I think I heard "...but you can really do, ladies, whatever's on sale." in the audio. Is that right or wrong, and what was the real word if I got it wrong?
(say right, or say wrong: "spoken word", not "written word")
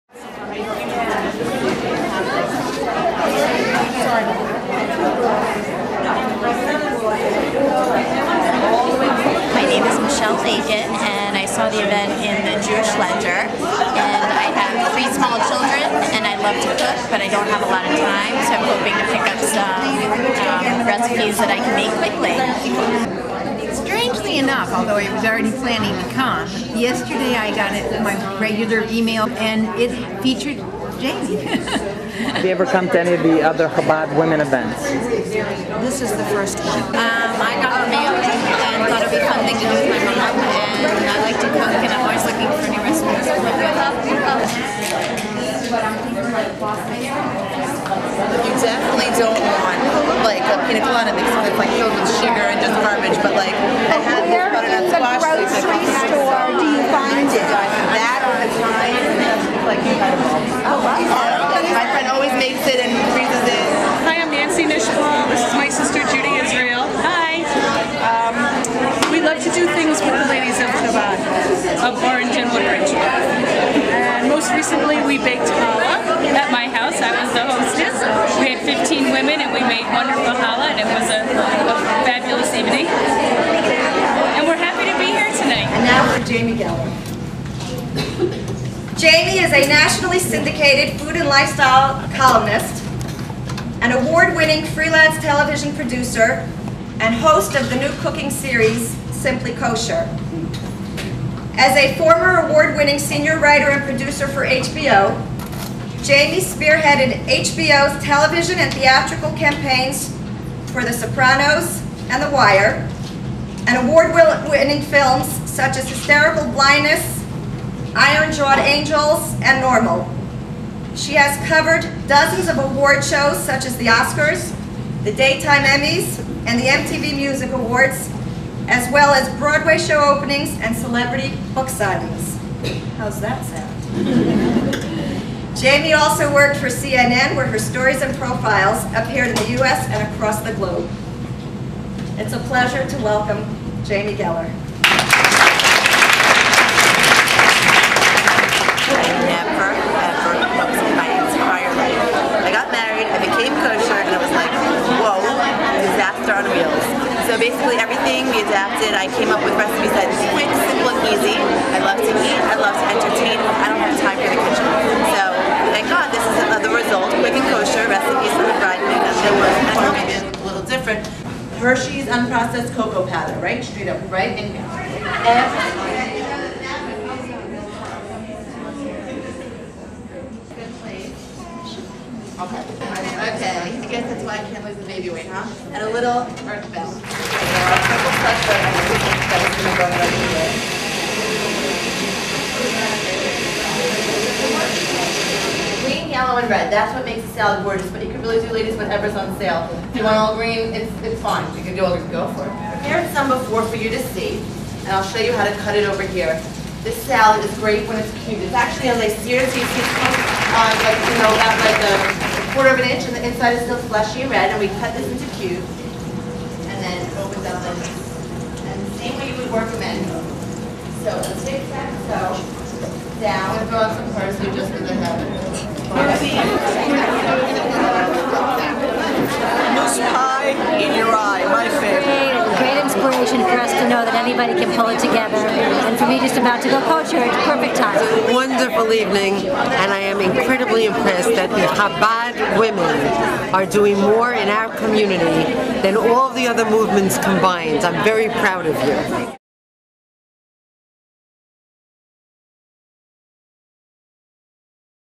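right.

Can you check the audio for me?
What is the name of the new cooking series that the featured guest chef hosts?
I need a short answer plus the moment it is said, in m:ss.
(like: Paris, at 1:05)
Simply Kosher, at 1:39.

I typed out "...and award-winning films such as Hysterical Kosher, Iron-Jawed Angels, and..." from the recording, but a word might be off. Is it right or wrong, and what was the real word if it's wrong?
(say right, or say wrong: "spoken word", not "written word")
wrong: "Blindness", not "Kosher".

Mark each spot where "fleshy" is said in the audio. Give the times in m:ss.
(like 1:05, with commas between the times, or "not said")
3:33.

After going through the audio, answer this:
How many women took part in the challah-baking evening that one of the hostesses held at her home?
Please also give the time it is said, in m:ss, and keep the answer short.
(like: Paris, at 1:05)
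15, at 1:18.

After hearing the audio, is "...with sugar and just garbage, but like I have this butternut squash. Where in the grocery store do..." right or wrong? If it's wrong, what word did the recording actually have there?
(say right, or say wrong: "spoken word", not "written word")
right.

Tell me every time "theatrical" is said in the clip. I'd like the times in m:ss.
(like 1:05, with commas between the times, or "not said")
1:48.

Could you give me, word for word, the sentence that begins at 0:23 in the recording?
Strangely enough, although I was already planning to come, yesterday I got it, my regular email and it featured Jamie.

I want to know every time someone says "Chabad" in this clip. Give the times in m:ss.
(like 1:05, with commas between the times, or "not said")
0:33, 4:01.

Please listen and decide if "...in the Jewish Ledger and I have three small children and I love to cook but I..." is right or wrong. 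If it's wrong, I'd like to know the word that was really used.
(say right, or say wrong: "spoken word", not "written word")
right.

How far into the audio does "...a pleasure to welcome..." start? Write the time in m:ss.
2:22.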